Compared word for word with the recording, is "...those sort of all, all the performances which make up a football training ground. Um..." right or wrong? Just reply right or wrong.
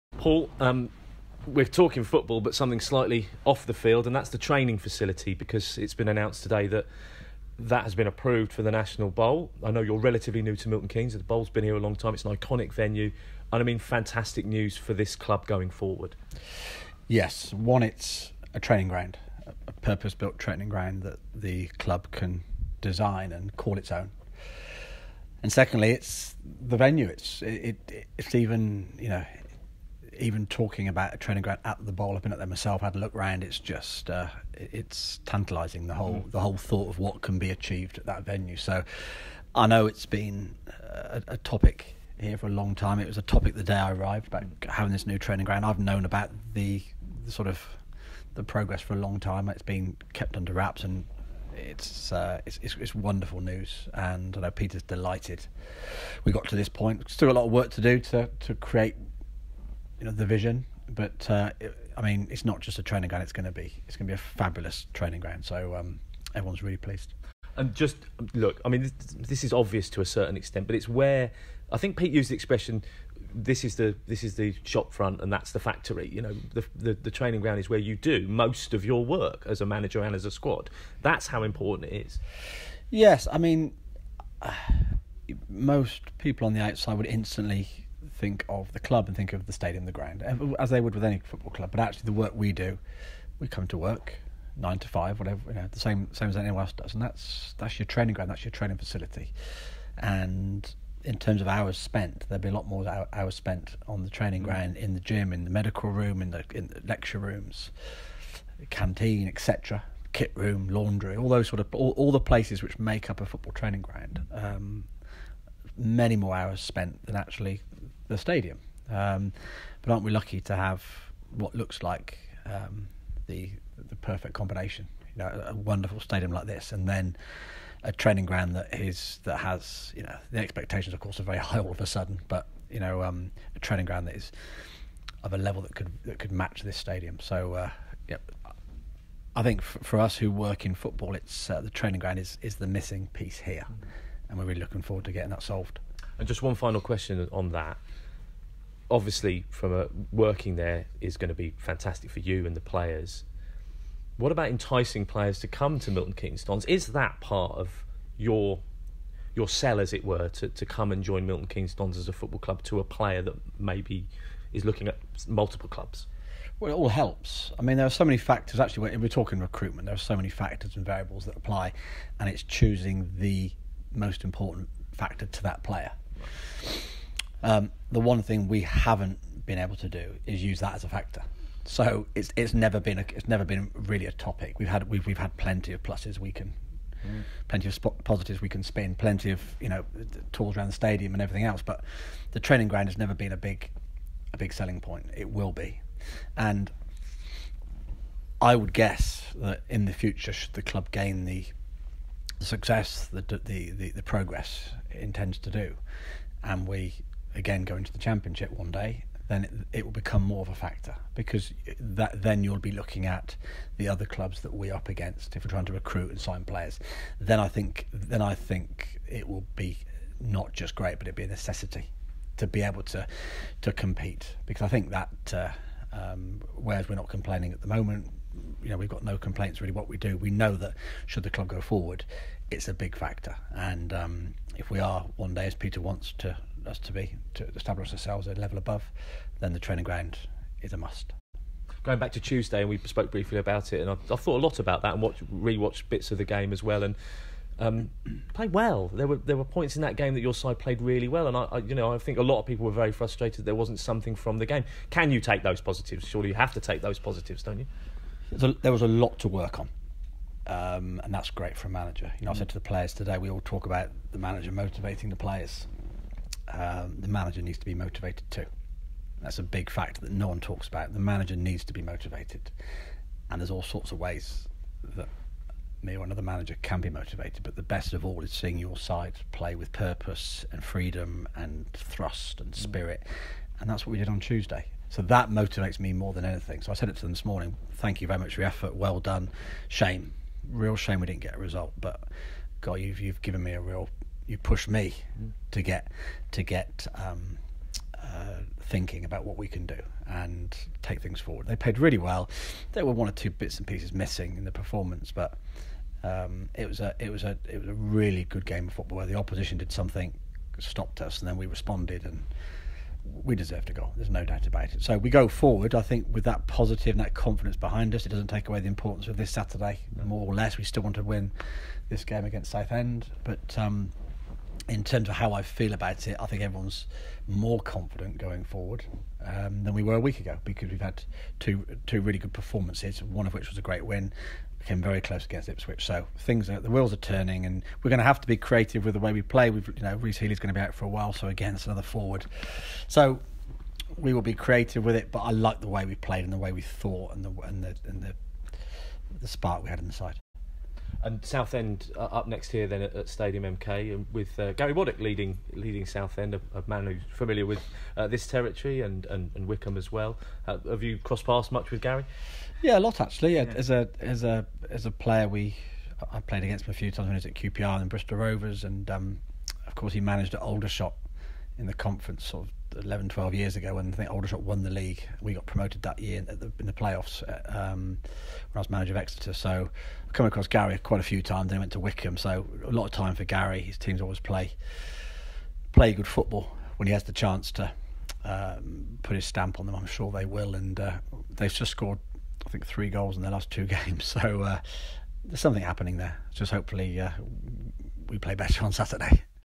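wrong.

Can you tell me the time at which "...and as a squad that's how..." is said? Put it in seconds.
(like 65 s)
80 s.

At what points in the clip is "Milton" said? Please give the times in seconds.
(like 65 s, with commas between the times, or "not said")
10 s, 155 s, 161 s.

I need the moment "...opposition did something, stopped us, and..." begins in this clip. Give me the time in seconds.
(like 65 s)
309 s.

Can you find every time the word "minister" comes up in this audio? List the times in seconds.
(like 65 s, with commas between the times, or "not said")
not said.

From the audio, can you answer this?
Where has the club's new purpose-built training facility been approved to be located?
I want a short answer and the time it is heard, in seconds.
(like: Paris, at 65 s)
National Bowl, at 8 s.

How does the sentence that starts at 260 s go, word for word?
Um, and that's great for a manager.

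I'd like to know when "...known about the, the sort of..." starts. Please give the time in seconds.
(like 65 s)
45 s.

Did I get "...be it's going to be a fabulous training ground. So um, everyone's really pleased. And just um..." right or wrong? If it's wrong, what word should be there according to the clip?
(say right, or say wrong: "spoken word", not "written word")
right.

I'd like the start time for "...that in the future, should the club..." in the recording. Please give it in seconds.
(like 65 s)
199 s.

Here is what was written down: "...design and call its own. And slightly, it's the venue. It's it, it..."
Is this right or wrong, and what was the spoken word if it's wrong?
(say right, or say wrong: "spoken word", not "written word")
wrong: "secondly", not "slightly".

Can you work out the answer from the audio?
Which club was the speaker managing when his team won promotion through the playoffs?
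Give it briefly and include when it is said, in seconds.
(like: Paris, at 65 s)
Exeter, at 378 s.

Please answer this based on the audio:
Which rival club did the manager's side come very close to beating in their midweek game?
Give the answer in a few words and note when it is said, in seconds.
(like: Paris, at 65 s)
Ipswich, at 335 s.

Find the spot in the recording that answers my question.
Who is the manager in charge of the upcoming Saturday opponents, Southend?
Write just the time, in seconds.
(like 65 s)
354 s.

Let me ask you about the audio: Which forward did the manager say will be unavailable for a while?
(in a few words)
Rhys Healey.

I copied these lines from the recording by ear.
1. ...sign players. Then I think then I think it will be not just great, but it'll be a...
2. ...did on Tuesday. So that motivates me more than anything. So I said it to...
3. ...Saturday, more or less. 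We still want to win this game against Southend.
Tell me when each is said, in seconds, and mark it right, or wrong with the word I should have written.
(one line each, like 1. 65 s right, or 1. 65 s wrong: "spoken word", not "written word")
1. 216 s right
2. 283 s right
3. 319 s right.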